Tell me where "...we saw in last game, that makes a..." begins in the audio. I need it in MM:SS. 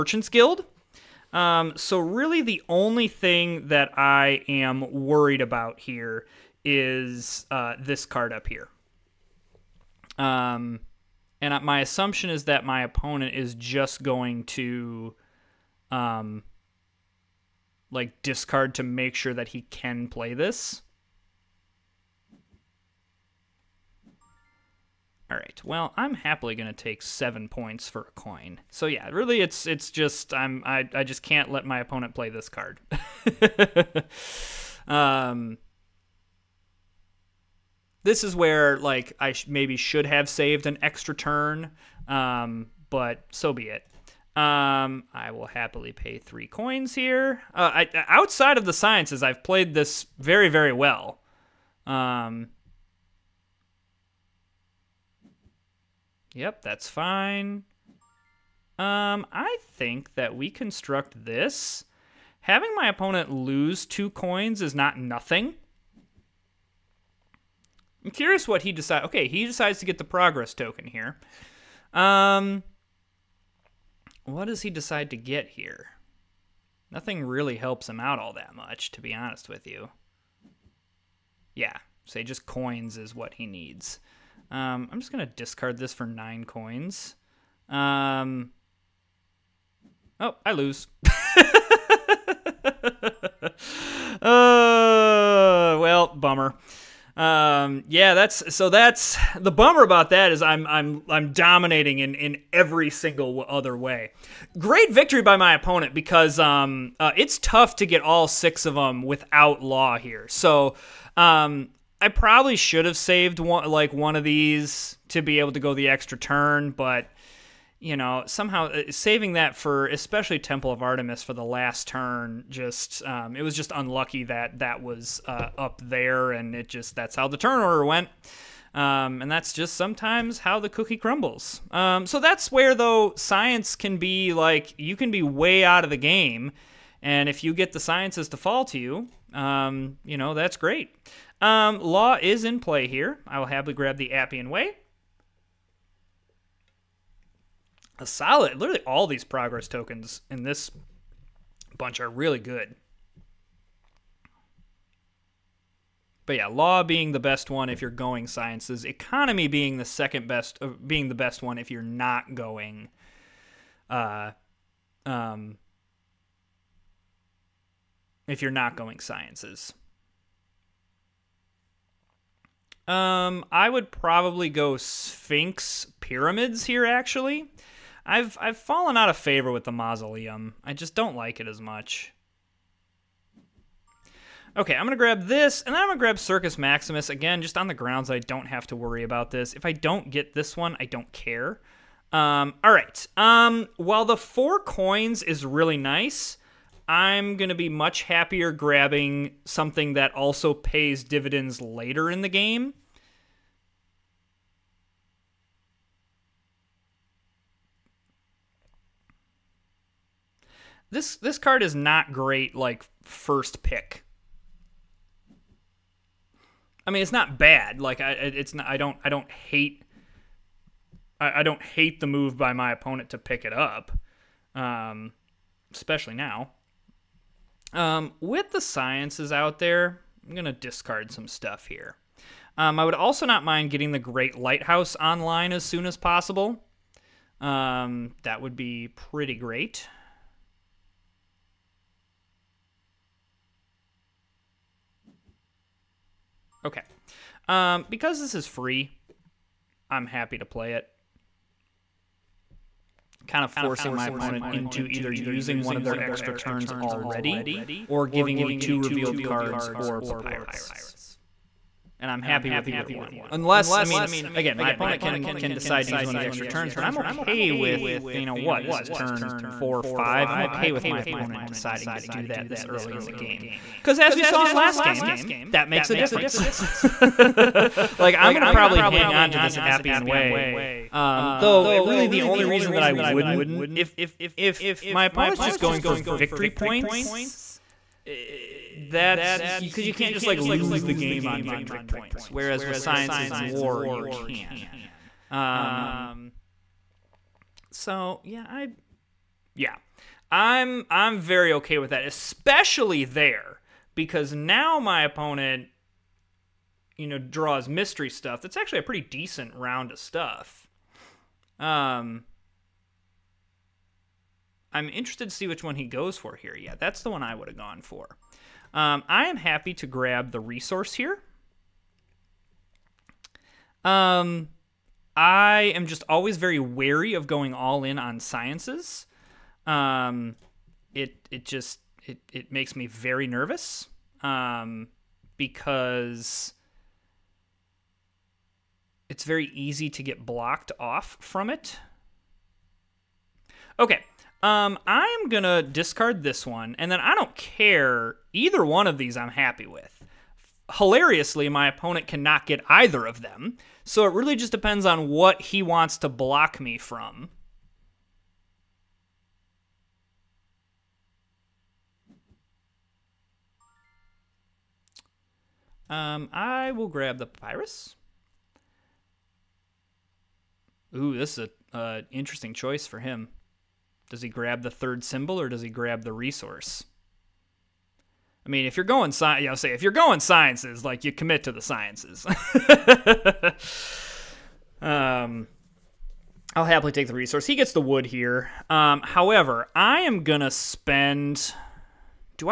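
04:34.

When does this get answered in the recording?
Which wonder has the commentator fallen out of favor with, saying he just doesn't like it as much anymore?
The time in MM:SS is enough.
02:59.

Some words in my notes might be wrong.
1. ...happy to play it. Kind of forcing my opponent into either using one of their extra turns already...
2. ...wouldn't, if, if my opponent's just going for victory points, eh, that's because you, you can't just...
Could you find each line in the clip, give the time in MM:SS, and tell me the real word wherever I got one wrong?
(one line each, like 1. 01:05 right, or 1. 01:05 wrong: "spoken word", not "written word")
1. 04:10 right
2. 04:42 right.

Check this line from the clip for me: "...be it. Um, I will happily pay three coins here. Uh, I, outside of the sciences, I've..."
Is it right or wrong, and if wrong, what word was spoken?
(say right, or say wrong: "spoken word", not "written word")
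right.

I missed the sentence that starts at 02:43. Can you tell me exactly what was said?
Uh, um, if you're not going sciences.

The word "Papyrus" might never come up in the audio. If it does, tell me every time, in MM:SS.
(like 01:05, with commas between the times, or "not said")
04:20, 06:07.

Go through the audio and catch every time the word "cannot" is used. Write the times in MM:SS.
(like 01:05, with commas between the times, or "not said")
05:52.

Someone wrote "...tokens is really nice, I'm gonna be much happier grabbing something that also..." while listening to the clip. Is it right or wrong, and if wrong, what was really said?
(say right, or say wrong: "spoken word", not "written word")
wrong: "coins", not "tokens".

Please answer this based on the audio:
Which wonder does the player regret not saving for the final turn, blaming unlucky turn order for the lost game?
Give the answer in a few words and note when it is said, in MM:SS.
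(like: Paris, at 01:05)
Temple of Artemis, at 02:00.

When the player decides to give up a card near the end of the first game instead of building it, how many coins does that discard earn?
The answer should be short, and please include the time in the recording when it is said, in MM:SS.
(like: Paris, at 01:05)
9, at 01:26.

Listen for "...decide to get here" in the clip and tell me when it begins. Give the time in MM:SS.
01:14.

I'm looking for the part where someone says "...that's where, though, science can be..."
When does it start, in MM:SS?
02:12.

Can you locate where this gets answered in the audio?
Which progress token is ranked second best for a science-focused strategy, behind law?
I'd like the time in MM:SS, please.
02:38.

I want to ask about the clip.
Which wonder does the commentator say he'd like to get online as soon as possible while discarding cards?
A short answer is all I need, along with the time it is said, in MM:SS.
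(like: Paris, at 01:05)
Great Lighthouse, at 03:53.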